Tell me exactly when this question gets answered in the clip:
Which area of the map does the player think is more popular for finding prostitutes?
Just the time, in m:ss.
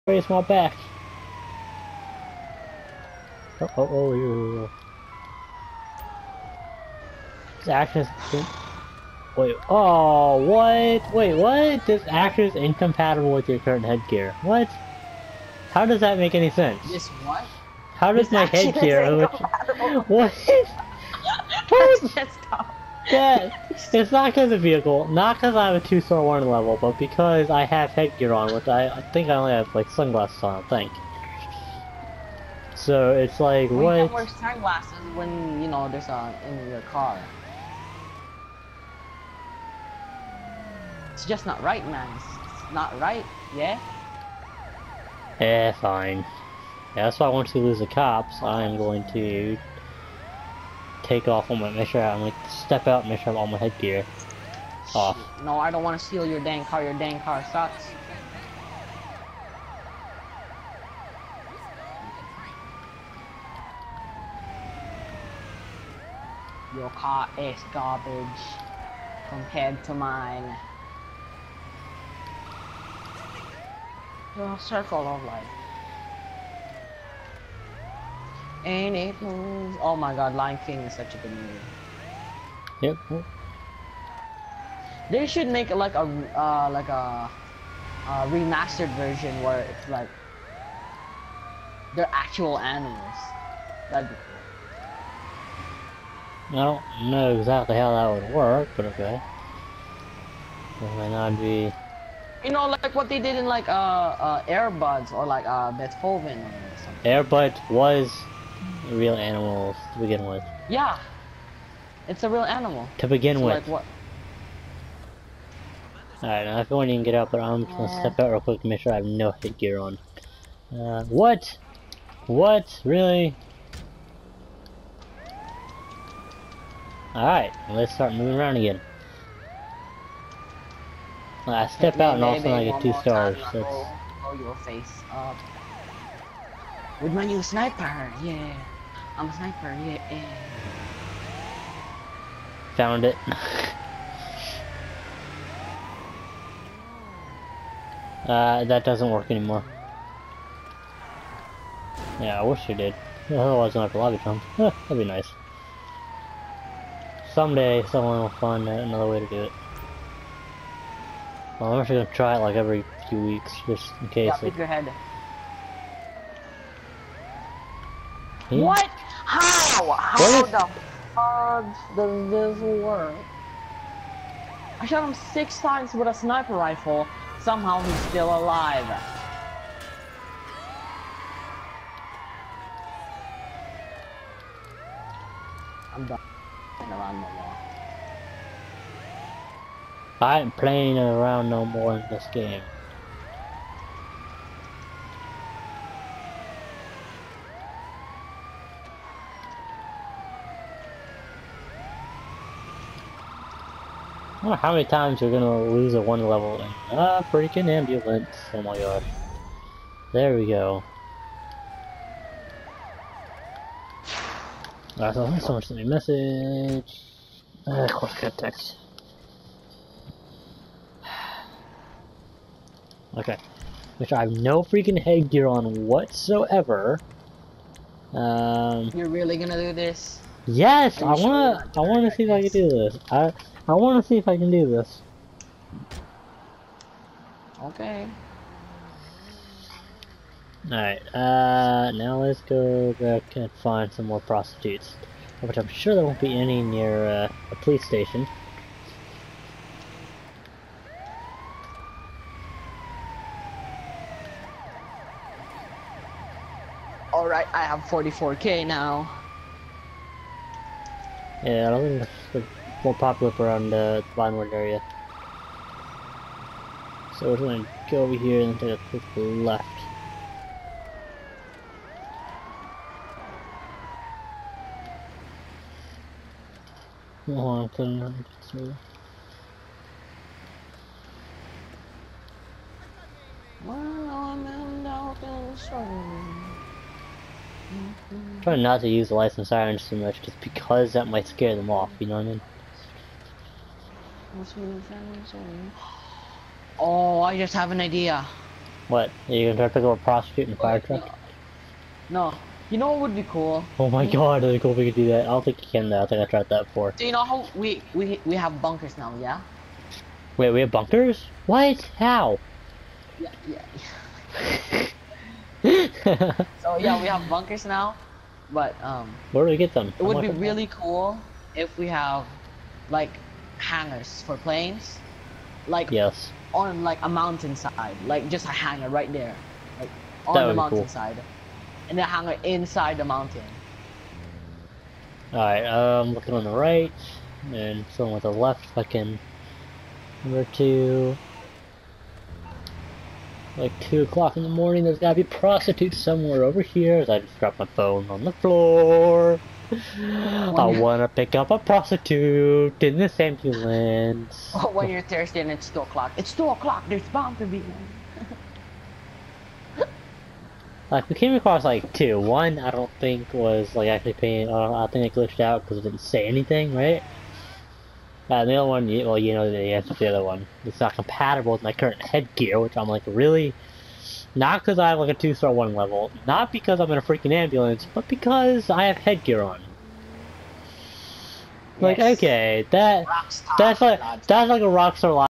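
4:24.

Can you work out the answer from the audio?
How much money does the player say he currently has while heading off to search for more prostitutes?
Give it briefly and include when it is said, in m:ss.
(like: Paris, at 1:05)
44k, at 4:17.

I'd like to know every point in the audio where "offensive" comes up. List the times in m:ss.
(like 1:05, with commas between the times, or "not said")
not said.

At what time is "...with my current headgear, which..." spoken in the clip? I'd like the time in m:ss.
6:11.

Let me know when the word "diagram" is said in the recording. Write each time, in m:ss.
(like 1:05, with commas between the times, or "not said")
not said.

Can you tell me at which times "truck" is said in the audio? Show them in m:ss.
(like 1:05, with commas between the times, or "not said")
5:00.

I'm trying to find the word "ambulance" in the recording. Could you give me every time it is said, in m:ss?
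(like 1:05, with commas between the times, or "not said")
3:27, 5:53, 6:17.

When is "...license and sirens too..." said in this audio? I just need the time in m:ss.
4:49.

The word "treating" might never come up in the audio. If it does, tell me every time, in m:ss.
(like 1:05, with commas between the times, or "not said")
not said.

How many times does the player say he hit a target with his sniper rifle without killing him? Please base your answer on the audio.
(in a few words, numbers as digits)
6.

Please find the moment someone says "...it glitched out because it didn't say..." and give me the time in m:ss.
6:05.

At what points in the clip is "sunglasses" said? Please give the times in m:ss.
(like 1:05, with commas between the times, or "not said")
0:29, 0:34.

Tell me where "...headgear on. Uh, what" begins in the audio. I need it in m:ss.
1:59.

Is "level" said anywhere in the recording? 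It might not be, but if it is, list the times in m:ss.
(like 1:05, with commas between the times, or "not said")
0:26, 3:26, 6:15.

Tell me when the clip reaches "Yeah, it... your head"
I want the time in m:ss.
2:44.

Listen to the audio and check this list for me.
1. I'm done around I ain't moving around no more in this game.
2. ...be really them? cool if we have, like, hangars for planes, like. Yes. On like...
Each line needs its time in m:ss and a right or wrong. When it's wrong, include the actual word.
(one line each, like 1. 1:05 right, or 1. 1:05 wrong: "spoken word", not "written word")
1. 3:05 wrong: "playing", not "moving"
2. 5:20 right.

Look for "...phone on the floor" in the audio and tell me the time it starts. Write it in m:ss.
5:47.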